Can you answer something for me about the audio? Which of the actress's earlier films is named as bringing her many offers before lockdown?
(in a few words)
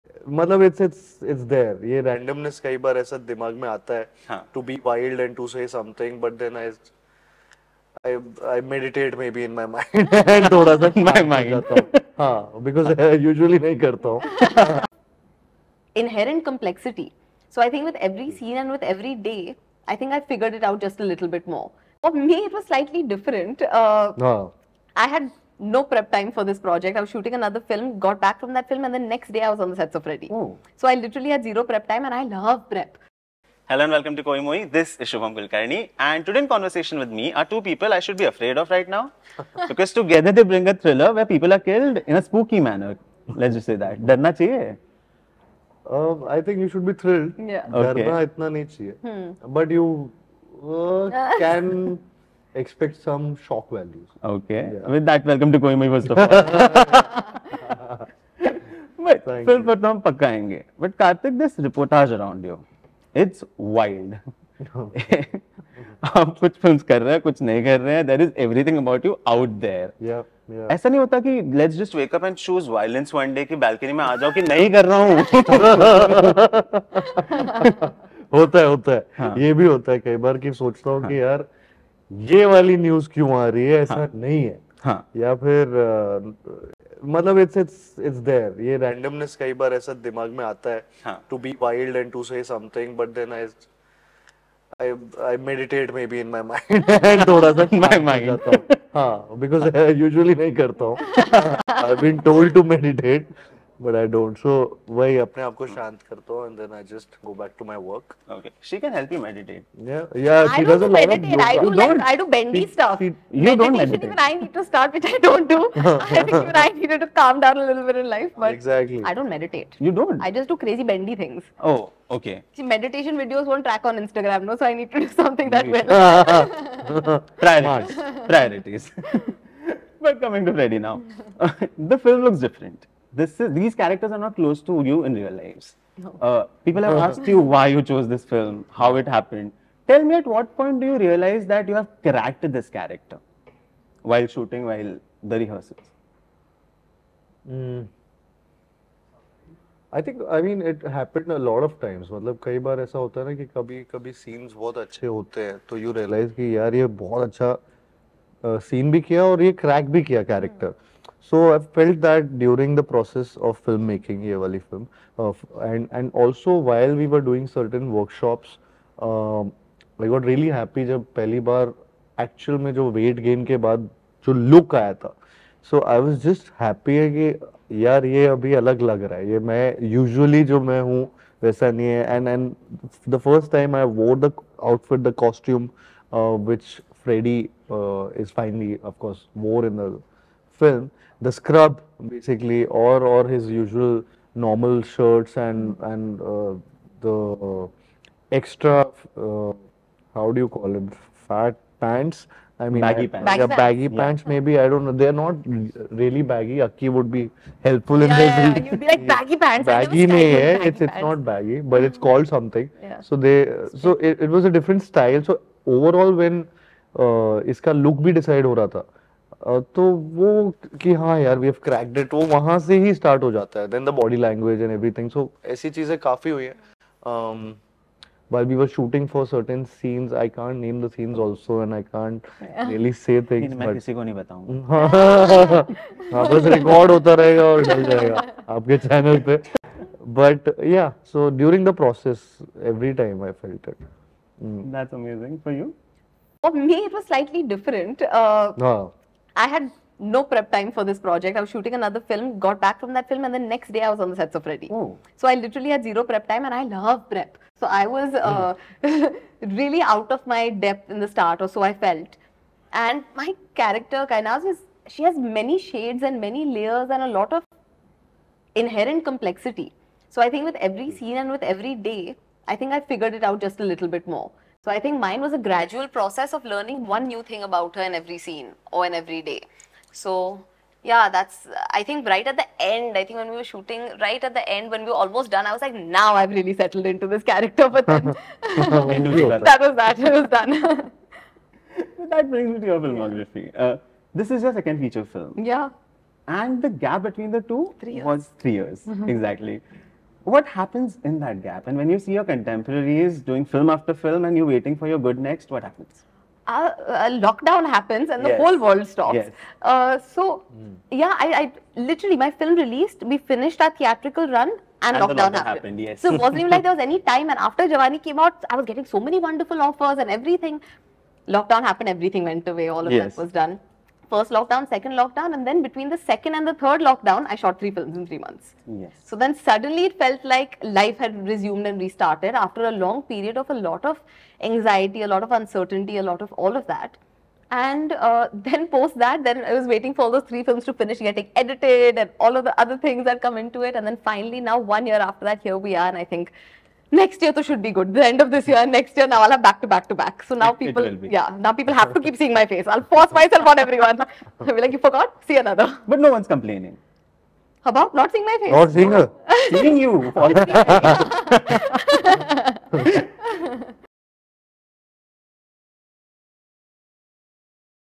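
Jawani.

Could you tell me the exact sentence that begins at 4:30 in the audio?
scene and with every day, I think I figured it out just a little bit more.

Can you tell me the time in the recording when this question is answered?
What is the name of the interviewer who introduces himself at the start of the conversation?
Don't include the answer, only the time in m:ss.
0:35.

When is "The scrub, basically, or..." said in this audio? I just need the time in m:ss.
3:11.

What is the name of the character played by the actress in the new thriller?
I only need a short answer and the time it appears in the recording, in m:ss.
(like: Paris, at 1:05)
Kainaz, at 4:24.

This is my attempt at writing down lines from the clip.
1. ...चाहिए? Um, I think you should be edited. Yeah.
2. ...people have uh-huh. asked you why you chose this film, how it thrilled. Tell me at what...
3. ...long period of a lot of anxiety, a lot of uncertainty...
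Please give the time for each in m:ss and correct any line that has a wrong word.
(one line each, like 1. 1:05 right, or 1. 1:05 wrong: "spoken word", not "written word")
1. 0:44 wrong: "thrilled", not "edited"
2. 2:16 wrong: "happened", not "thrilled"
3. 5:32 right.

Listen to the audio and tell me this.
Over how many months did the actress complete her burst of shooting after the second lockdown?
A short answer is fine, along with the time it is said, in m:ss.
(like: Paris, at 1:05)
3, at 5:28.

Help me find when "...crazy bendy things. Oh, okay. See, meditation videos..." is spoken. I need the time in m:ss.
2:00.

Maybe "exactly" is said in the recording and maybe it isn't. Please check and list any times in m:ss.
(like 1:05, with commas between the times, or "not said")
1:58, 4:59.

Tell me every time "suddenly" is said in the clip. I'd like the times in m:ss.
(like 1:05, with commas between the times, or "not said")
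5:29.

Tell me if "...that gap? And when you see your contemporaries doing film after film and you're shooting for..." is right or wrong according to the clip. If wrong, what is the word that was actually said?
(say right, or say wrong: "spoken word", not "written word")
wrong: "waiting", not "shooting".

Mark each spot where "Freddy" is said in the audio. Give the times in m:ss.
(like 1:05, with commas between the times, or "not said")
0:30, 2:10, 3:07, 4:14.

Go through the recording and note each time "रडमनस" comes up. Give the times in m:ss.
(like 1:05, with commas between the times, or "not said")
0:02, 1:28.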